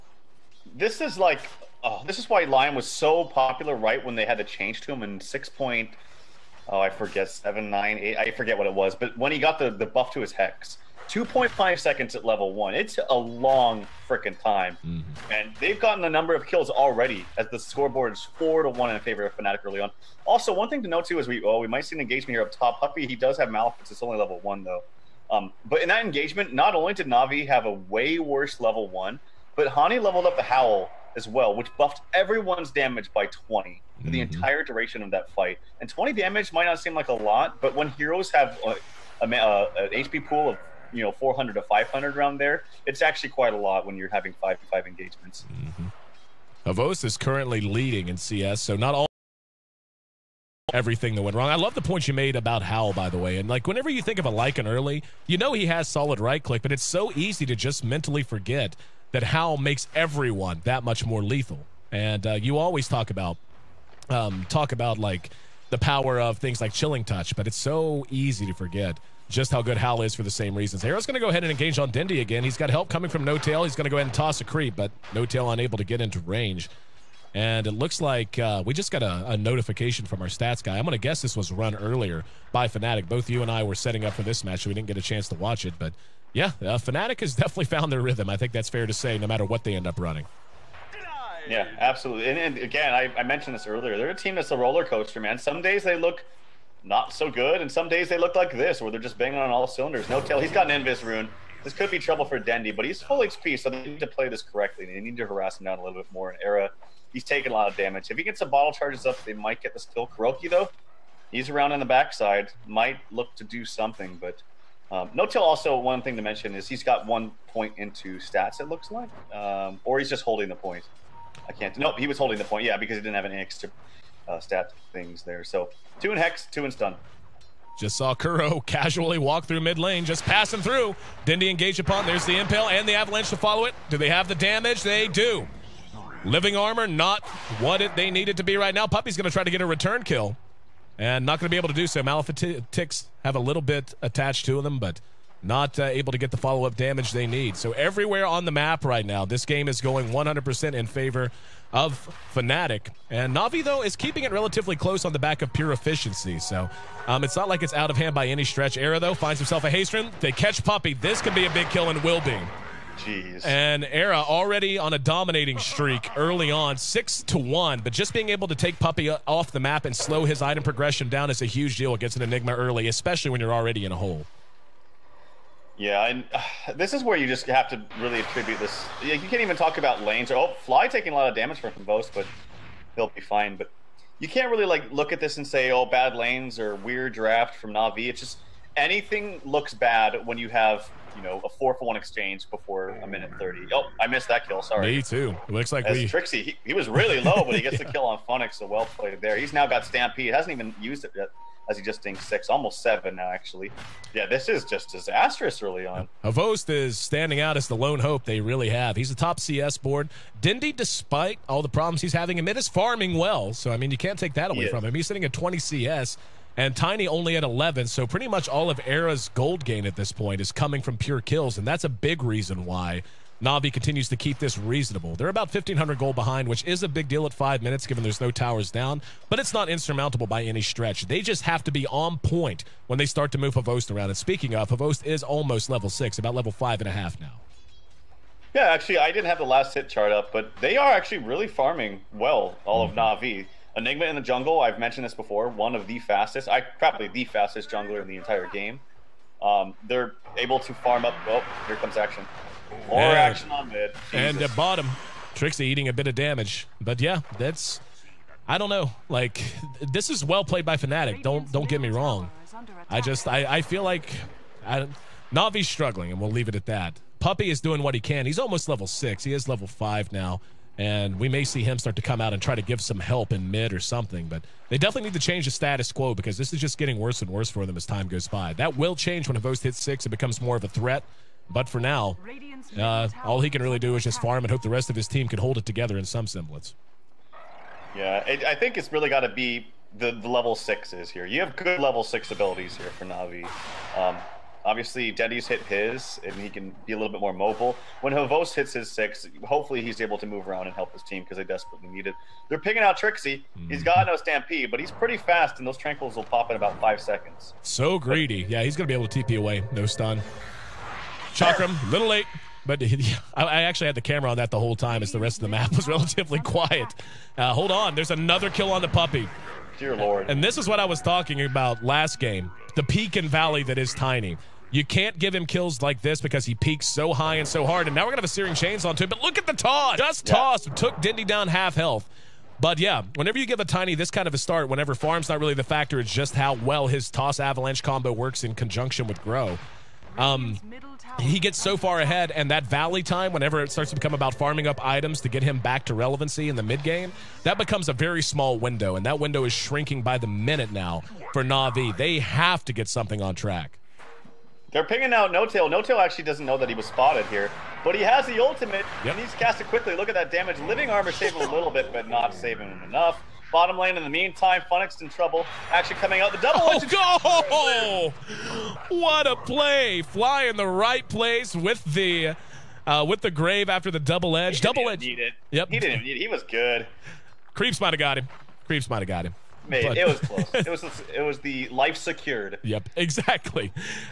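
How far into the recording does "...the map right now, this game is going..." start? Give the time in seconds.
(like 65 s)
148 s.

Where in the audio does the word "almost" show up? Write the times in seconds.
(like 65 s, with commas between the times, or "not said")
202 s, 235 s, 268 s.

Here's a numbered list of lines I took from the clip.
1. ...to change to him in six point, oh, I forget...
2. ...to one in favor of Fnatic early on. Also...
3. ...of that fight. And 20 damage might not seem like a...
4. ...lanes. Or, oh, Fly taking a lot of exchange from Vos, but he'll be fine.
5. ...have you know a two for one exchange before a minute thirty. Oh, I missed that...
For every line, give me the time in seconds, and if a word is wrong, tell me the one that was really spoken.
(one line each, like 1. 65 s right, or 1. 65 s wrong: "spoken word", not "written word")
1. 4 s right
2. 18 s right
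3. 35 s right
4. 180 s wrong: "damage", not "exchange"
5. 190 s wrong: "four", not "two".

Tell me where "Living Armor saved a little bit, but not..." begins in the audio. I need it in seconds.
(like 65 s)
360 s.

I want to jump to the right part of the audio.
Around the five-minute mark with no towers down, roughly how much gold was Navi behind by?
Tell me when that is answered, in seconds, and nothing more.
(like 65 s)
225 s.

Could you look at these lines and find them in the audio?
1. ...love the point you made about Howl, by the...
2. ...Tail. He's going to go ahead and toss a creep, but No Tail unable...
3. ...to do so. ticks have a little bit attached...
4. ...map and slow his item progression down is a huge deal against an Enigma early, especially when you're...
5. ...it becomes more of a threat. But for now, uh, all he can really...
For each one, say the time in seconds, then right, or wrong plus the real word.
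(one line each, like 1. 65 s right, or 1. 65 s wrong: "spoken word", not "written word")
1. 51 s right
2. 73 s right
3. 141 s right
4. 169 s right
5. 280 s right.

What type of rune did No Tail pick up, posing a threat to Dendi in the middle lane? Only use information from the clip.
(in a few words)
Invis rune.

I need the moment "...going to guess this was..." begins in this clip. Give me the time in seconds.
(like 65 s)
80 s.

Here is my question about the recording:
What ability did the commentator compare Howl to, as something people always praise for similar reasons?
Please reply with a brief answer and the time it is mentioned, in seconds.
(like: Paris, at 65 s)
chilling touch, at 66 s.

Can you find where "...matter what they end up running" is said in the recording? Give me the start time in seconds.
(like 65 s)
89 s.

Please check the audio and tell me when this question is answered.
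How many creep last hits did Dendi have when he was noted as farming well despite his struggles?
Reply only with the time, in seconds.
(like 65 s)
215 s.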